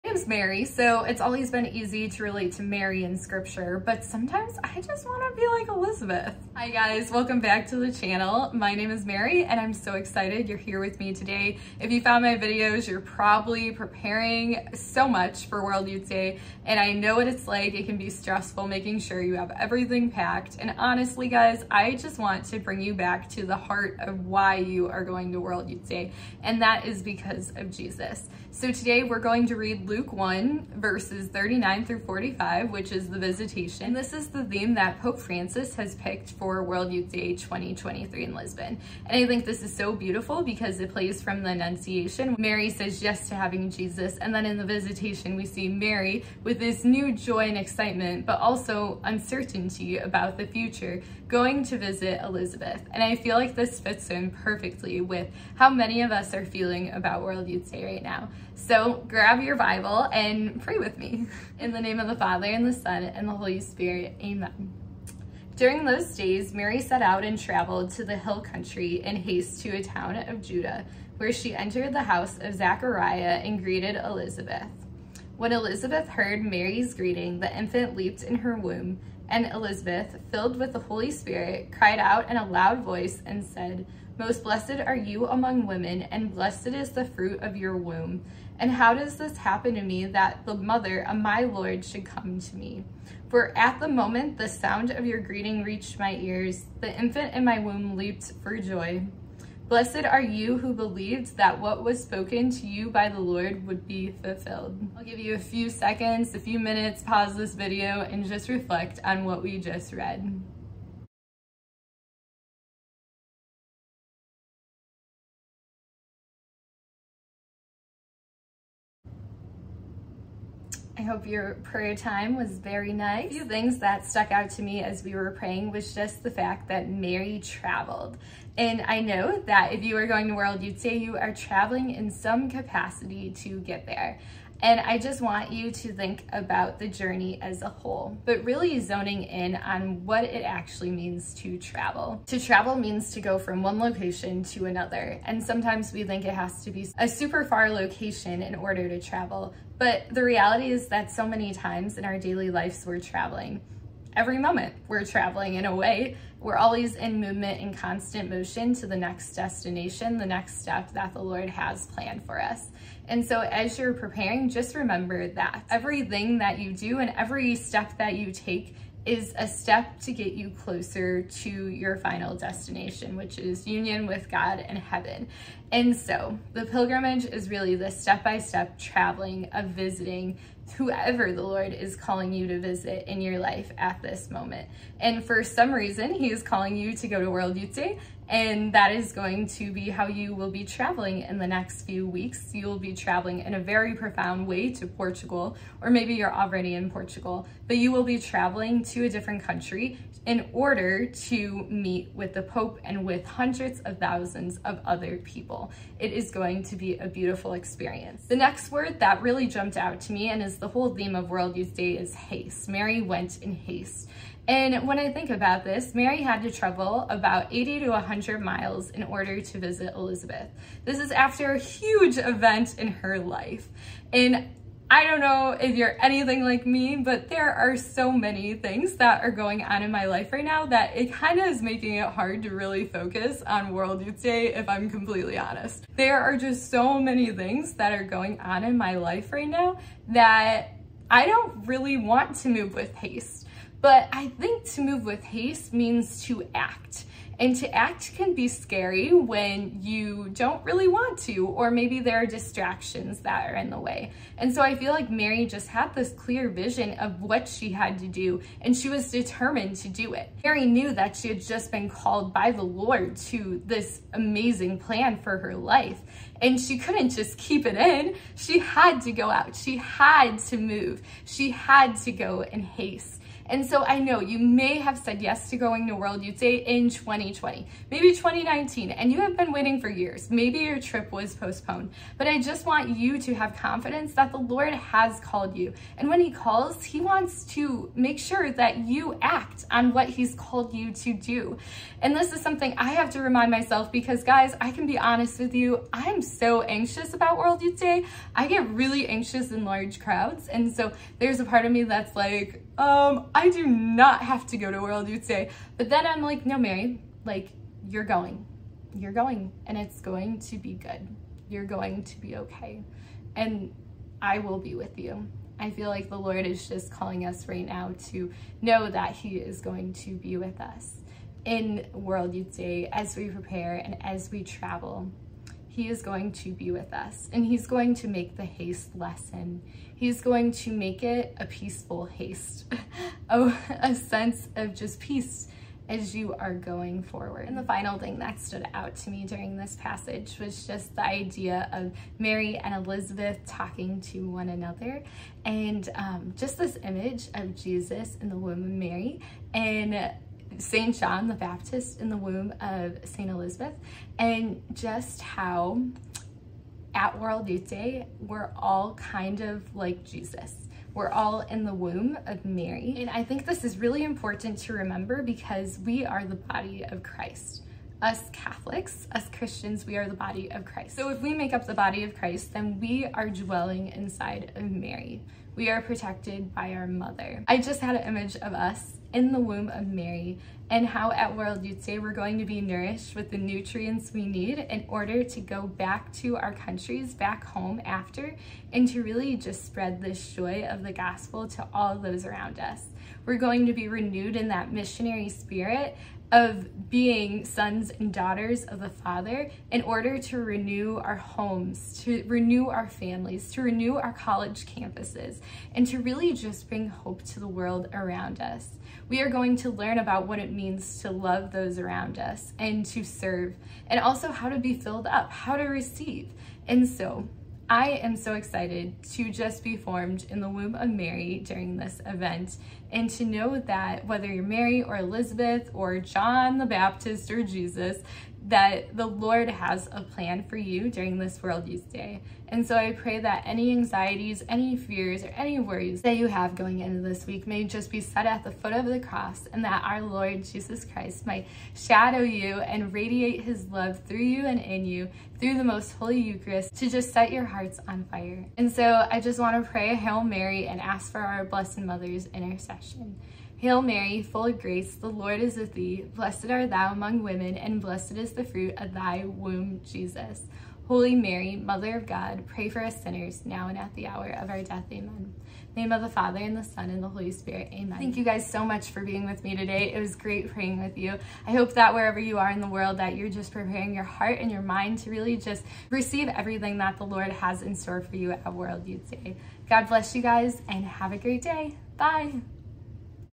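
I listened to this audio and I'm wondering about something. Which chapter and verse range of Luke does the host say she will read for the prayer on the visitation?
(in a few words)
Luke 1:39-45.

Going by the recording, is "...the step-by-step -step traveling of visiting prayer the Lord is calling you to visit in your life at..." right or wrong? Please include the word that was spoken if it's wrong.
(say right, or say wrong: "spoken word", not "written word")
wrong: "whoever", not "prayer".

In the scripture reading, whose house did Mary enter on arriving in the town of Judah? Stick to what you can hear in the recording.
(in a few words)
Zachariah.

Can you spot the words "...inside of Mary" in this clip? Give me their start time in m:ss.
6:13.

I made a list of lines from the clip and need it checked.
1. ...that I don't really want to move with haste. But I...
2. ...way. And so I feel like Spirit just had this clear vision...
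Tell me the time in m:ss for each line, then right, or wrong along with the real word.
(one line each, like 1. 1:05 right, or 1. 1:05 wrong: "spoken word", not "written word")
1. 4:00 right
2. 4:13 wrong: "Mary", not "Spirit".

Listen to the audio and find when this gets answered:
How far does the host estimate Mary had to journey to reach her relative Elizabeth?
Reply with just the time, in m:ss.
3:37.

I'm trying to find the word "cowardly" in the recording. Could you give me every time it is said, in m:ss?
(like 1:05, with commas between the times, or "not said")
not said.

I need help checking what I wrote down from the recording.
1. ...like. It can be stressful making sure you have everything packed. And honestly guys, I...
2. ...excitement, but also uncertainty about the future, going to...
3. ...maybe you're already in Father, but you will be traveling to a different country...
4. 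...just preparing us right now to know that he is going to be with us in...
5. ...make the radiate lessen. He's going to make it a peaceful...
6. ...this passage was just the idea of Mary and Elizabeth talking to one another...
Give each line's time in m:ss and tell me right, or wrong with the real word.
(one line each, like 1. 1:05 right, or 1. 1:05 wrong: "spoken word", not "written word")
1. 0:17 right
2. 0:47 right
3. 3:15 wrong: "Portugal", not "Father"
4. 5:16 wrong: "calling", not "preparing"
5. 5:28 wrong: "haste", not "radiate"
6. 5:39 right.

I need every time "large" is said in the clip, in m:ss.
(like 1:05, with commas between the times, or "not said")
4:59.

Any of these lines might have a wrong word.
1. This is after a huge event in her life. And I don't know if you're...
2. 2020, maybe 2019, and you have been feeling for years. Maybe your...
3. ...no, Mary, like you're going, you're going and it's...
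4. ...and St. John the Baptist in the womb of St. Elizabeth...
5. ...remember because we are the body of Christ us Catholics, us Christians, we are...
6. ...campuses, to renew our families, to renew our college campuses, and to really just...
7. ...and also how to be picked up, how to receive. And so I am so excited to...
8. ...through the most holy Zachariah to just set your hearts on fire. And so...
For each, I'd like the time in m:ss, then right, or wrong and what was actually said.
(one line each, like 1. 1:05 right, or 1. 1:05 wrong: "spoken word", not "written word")
1. 3:40 right
2. 4:37 wrong: "waiting", not "feeling"
3. 5:06 right
4. 5:49 right
5. 6:04 right
6. 6:41 wrong: "homes", not "campuses"
7. 6:53 wrong: "filled", not "picked"
8. 7:25 wrong: "Eucharist", not "Zachariah".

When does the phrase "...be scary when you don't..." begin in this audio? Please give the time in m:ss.
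4:08.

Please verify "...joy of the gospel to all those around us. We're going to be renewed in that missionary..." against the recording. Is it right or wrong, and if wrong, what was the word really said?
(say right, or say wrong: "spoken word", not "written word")
right.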